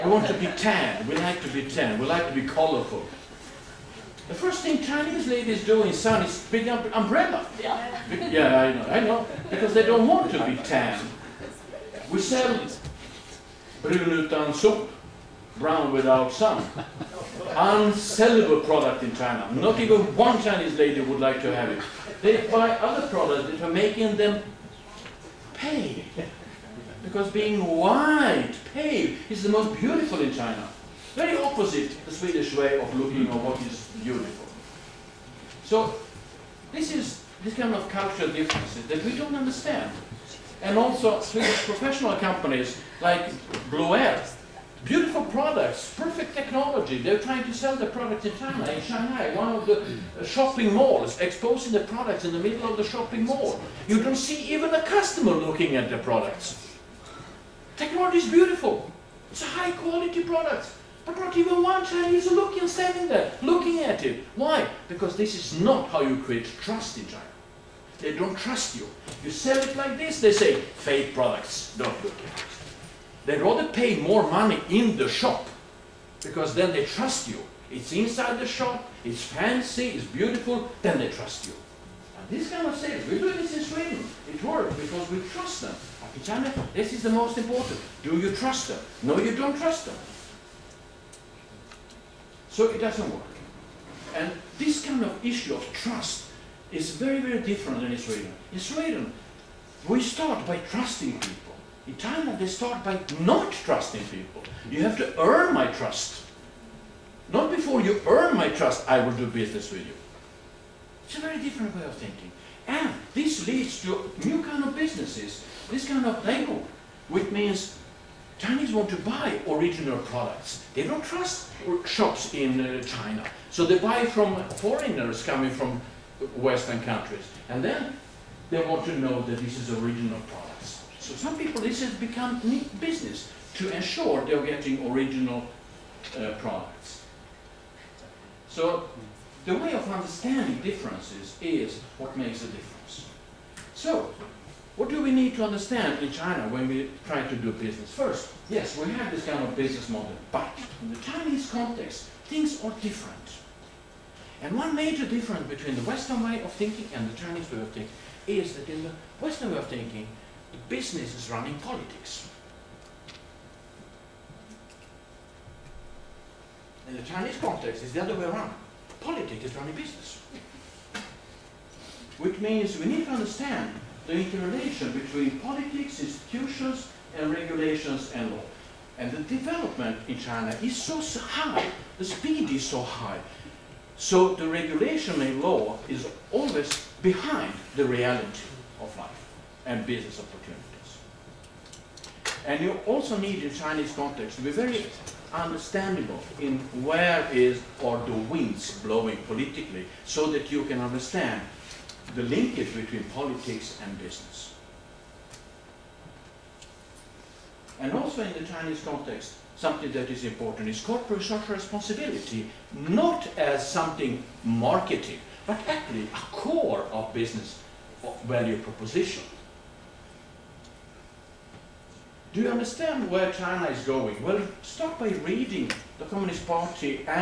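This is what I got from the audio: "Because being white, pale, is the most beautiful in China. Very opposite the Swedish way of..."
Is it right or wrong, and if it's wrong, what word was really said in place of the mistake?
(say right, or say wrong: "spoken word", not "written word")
right.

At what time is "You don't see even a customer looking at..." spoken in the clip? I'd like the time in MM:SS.
00:53.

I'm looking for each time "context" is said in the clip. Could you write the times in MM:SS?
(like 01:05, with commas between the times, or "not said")
02:31, 02:47, 03:13, 03:28.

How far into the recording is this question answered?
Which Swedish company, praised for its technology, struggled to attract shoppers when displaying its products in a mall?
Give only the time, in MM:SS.
00:43.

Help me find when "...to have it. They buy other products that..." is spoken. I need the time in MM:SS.
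00:21.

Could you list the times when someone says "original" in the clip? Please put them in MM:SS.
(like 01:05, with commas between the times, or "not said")
01:59, 02:09, 02:14.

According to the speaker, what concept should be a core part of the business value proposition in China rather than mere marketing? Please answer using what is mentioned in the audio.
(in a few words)
Corporate social responsibility.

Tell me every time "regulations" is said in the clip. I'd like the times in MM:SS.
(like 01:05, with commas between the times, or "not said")
02:57, 03:04.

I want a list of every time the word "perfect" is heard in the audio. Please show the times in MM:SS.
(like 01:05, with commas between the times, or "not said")
00:45.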